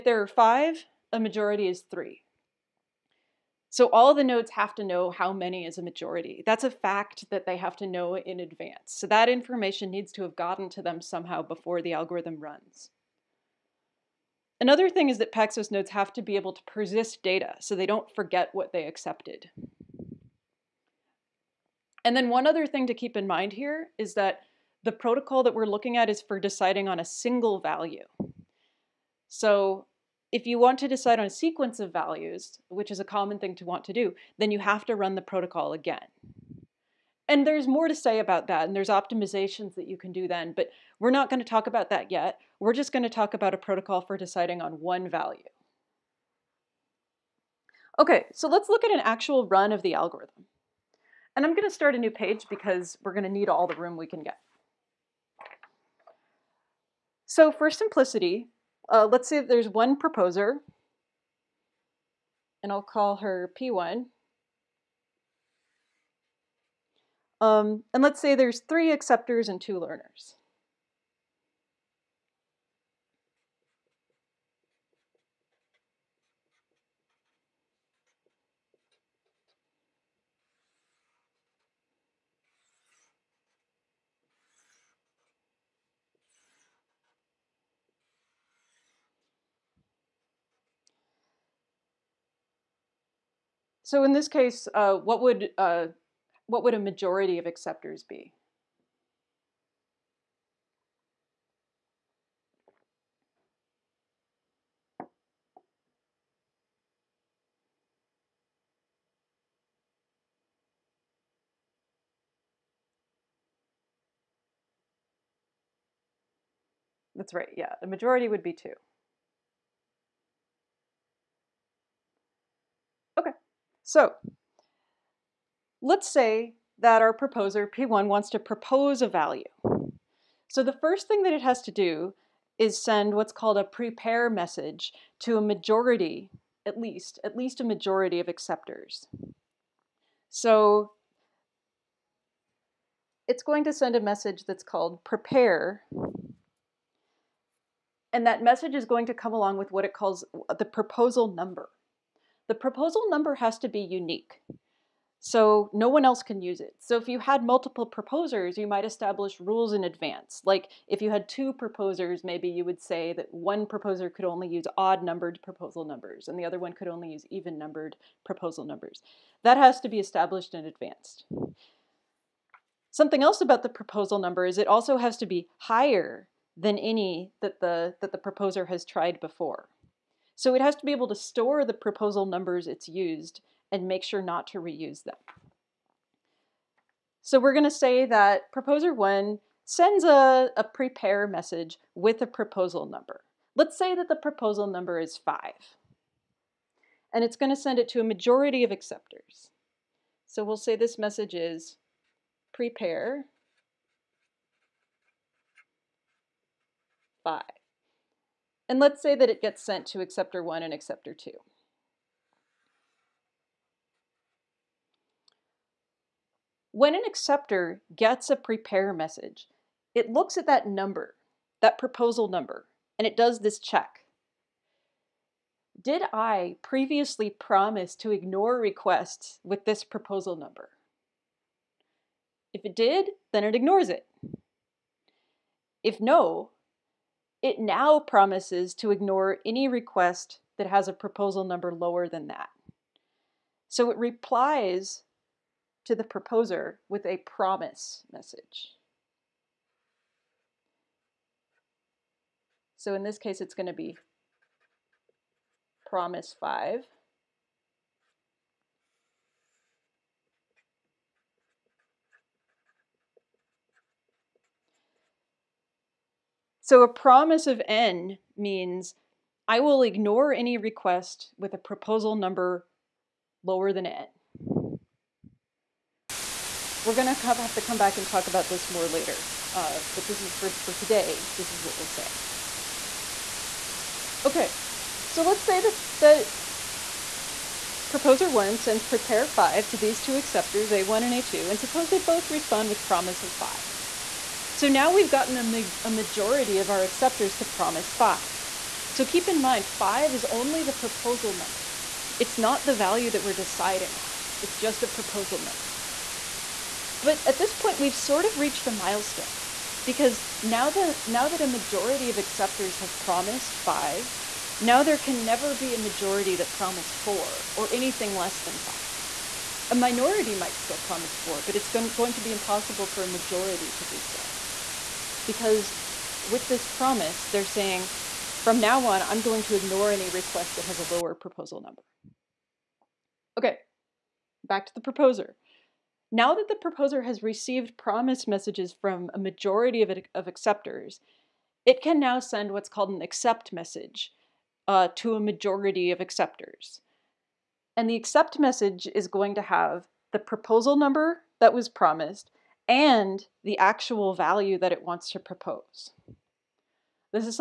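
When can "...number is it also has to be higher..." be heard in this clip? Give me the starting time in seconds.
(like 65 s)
174 s.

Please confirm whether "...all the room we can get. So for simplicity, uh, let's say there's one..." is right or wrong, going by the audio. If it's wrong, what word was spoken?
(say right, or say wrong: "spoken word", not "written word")
right.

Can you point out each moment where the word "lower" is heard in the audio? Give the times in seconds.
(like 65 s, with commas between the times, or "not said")
241 s, 273 s, 330 s.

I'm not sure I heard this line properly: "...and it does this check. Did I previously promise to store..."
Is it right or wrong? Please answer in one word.
wrong.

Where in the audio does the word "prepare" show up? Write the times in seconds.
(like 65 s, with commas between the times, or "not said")
133 s, 145 s, 190 s, 202 s, 218 s, 288 s.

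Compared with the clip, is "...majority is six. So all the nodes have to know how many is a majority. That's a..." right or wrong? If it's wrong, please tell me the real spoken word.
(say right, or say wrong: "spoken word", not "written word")
wrong: "three", not "six".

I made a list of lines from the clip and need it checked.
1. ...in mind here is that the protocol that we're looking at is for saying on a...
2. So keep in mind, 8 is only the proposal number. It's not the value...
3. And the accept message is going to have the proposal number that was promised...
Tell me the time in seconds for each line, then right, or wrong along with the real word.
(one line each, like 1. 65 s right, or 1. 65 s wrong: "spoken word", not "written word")
1. 23 s wrong: "deciding", not "saying"
2. 298 s wrong: "5", not "8"
3. 347 s right.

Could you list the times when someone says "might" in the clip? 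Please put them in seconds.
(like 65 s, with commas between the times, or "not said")
158 s, 320 s.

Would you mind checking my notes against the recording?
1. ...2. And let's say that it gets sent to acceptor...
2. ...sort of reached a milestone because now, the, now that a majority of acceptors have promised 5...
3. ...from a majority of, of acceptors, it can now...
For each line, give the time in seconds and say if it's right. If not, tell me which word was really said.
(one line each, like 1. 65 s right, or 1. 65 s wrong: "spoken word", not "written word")
1. 207 s wrong: "5", not "2"
2. 307 s right
3. 338 s right.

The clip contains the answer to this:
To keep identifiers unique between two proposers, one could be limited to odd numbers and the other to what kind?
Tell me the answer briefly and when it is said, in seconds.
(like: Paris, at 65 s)
even numbered, at 167 s.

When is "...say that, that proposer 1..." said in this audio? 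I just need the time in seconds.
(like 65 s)
285 s.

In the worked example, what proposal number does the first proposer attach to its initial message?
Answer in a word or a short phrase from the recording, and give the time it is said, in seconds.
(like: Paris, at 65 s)
5, at 194 s.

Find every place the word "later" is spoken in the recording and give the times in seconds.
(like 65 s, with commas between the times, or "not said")
278 s.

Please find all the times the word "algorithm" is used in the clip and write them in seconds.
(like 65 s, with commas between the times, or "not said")
11 s, 49 s.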